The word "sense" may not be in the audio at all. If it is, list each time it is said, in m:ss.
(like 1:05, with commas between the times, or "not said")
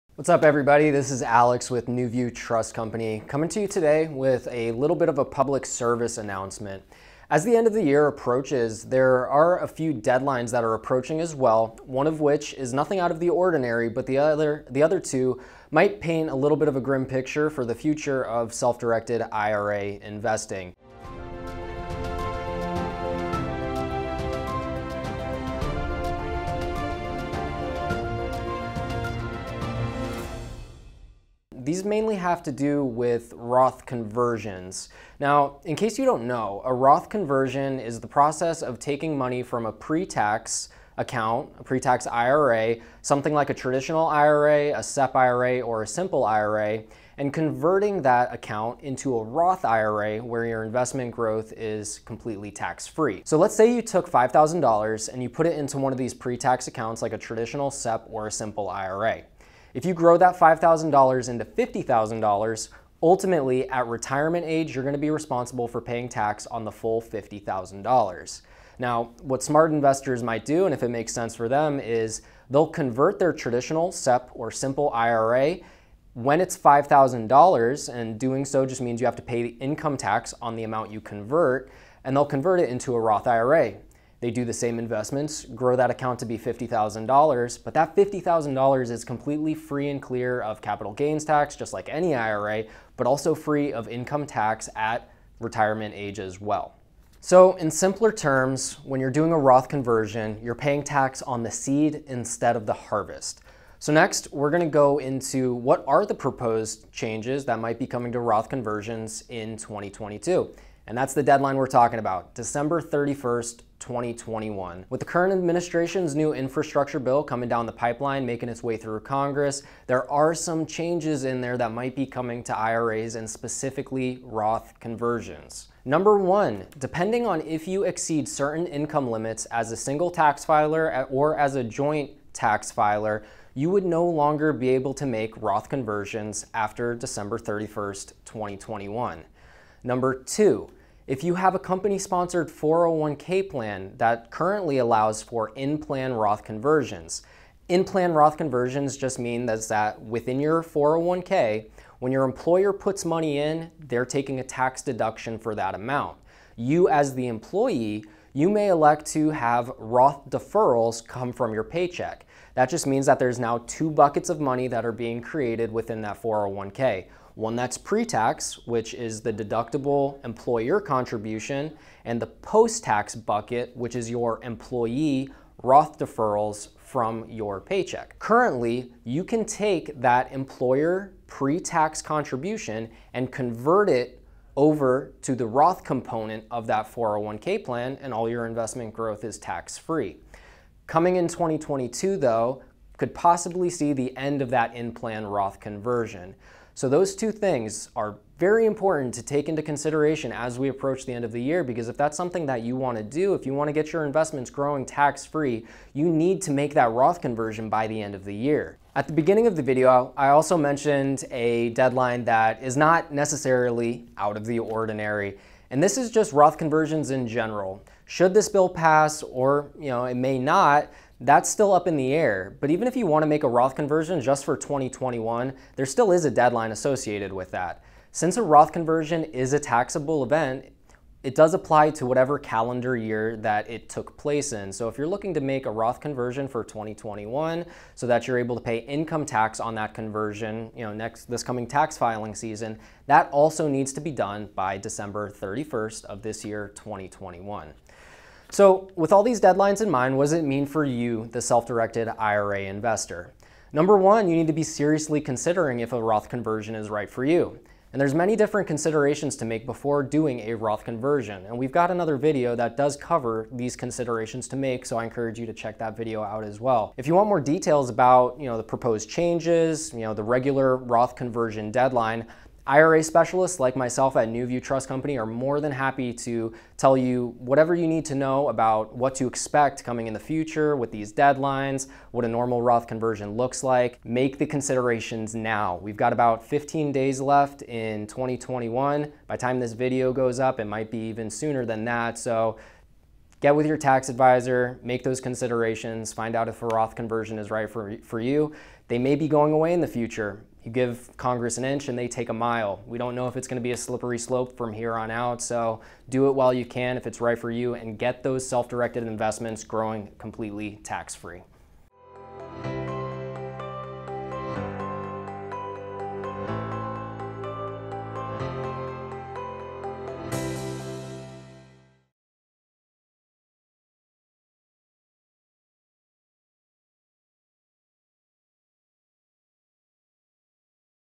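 1:11.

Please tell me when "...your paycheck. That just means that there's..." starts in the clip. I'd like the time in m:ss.
2:41.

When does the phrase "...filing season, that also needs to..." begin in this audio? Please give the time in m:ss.
4:01.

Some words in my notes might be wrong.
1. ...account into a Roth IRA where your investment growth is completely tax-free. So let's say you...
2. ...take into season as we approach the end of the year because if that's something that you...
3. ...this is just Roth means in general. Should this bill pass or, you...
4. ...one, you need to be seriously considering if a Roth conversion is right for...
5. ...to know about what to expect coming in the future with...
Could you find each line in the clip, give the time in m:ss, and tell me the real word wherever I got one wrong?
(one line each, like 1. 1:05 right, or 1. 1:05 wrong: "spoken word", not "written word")
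1. 0:48 right
2. 3:19 wrong: "consideration", not "season"
3. 3:35 wrong: "conversions", not "means"
4. 4:13 right
5. 4:38 right.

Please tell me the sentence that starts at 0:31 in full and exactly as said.
these mainly have to do with Roth conversions.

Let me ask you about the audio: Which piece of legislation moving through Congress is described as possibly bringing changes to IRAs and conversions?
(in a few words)
infrastructure bill.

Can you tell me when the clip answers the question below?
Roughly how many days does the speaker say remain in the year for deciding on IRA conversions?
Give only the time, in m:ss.
4:46.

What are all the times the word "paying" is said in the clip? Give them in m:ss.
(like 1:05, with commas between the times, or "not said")
1:05, 1:40.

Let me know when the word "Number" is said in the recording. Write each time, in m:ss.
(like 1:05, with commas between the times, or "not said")
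2:05, 2:19, 4:13.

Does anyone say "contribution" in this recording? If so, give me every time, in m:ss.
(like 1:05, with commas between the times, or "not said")
2:50, 3:02.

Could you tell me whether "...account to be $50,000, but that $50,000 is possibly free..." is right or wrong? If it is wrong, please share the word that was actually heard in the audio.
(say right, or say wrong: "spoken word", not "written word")
wrong: "completely", not "possibly".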